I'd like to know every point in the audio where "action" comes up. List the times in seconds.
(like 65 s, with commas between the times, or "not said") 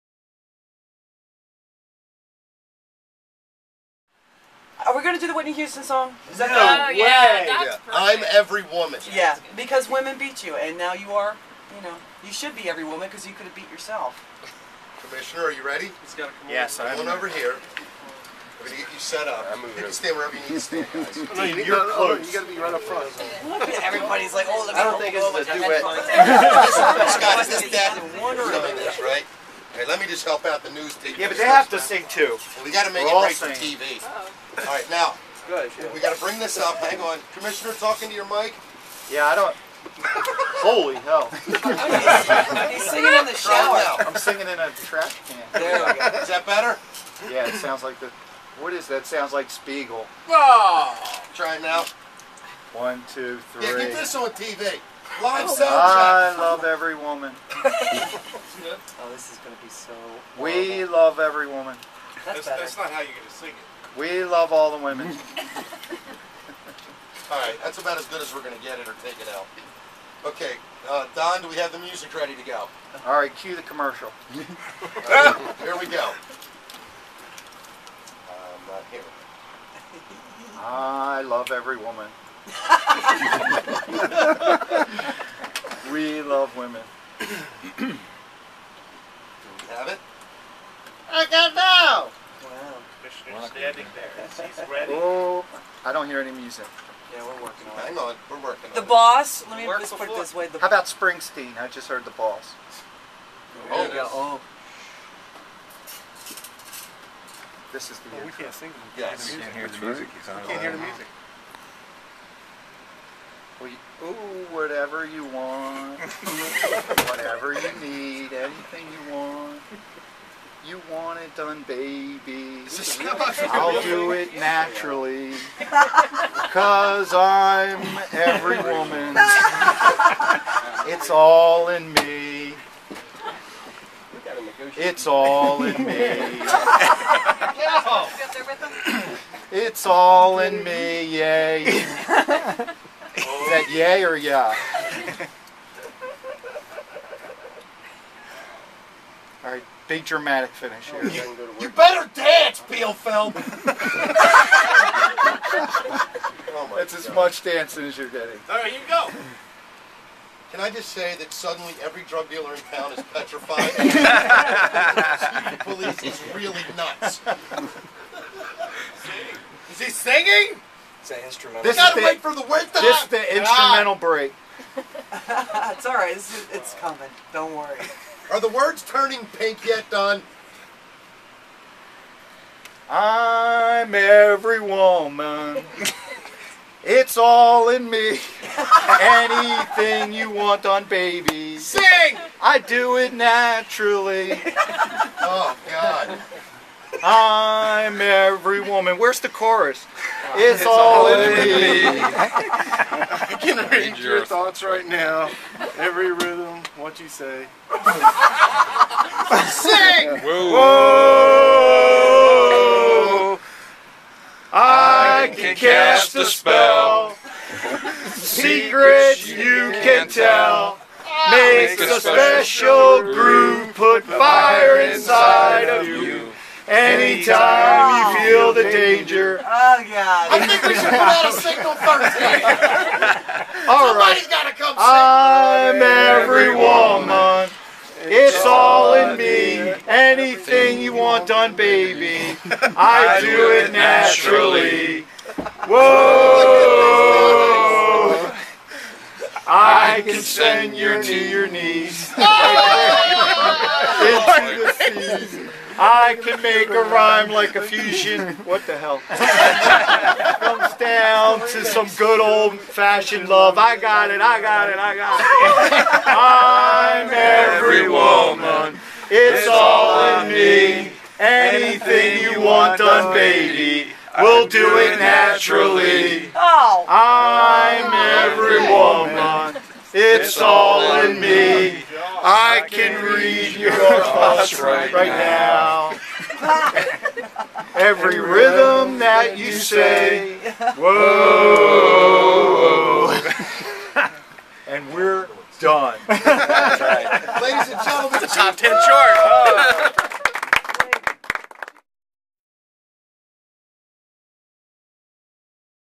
not said.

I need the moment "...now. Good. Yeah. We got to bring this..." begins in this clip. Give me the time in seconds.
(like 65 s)
34 s.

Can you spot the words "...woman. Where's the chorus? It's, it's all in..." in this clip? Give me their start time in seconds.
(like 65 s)
198 s.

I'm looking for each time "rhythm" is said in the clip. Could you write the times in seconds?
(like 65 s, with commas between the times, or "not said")
206 s, 288 s.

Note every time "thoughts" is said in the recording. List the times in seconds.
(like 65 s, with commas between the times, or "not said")
204 s, 283 s.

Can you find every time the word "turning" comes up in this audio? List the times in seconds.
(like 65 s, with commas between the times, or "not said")
178 s.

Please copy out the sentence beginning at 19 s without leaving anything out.
You can stand wherever you need to stand, guys.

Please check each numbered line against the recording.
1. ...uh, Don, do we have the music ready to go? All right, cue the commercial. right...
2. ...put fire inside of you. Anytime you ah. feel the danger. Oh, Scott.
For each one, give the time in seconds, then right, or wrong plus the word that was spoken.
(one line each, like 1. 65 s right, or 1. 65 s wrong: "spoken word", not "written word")
1. 70 s right
2. 223 s wrong: "God", not "Scott".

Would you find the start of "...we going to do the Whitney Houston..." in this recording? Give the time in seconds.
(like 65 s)
4 s.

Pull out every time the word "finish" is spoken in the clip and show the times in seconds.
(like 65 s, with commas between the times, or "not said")
150 s.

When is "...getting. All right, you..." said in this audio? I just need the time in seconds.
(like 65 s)
158 s.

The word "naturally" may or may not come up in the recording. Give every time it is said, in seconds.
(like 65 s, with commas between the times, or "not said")
124 s, 193 s, 243 s, 274 s.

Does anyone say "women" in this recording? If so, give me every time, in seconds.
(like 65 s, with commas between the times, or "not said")
9 s, 64 s, 86 s.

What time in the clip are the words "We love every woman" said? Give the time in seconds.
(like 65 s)
60 s.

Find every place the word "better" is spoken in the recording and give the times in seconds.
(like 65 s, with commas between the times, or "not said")
46 s, 151 s.